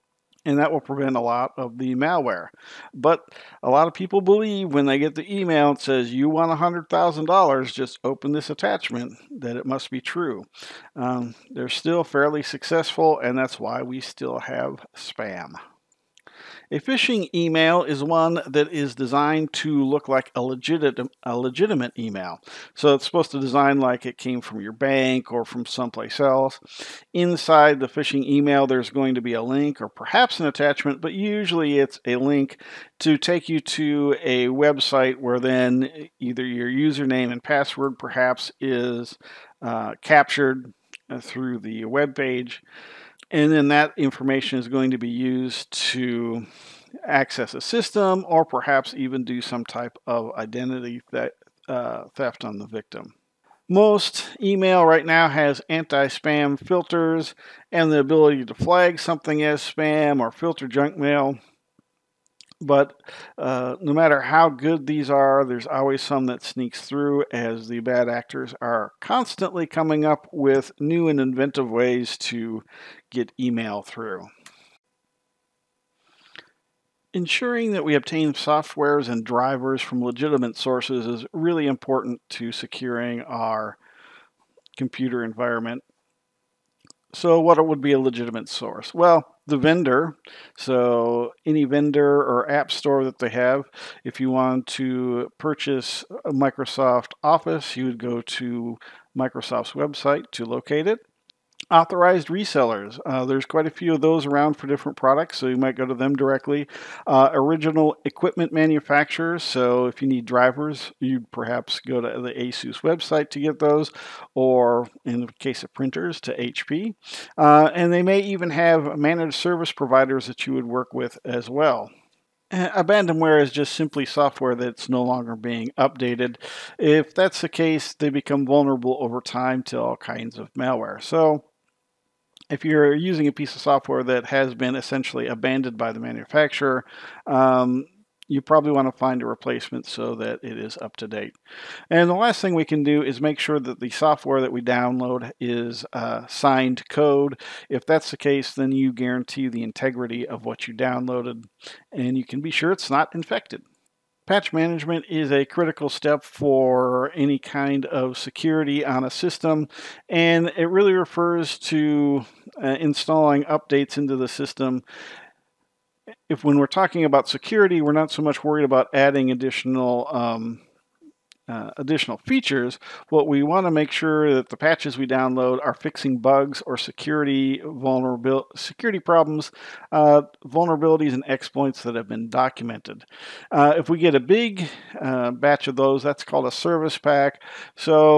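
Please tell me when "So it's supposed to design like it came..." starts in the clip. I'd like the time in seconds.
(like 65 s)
22 s.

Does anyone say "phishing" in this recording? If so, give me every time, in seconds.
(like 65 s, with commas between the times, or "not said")
16 s, 27 s.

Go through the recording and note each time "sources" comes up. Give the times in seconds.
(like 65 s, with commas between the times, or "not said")
80 s, 88 s.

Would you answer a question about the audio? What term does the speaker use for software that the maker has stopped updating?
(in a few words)
abandonware.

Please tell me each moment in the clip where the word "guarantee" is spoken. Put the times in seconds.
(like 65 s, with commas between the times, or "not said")
148 s.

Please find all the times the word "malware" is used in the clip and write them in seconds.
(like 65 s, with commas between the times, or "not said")
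1 s, 130 s.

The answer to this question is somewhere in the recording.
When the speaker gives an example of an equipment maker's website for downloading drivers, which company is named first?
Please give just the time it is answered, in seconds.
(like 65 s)
112 s.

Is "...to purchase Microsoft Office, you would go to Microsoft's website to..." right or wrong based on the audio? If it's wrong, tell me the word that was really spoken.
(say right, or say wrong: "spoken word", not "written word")
right.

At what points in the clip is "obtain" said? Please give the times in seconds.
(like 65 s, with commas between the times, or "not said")
77 s.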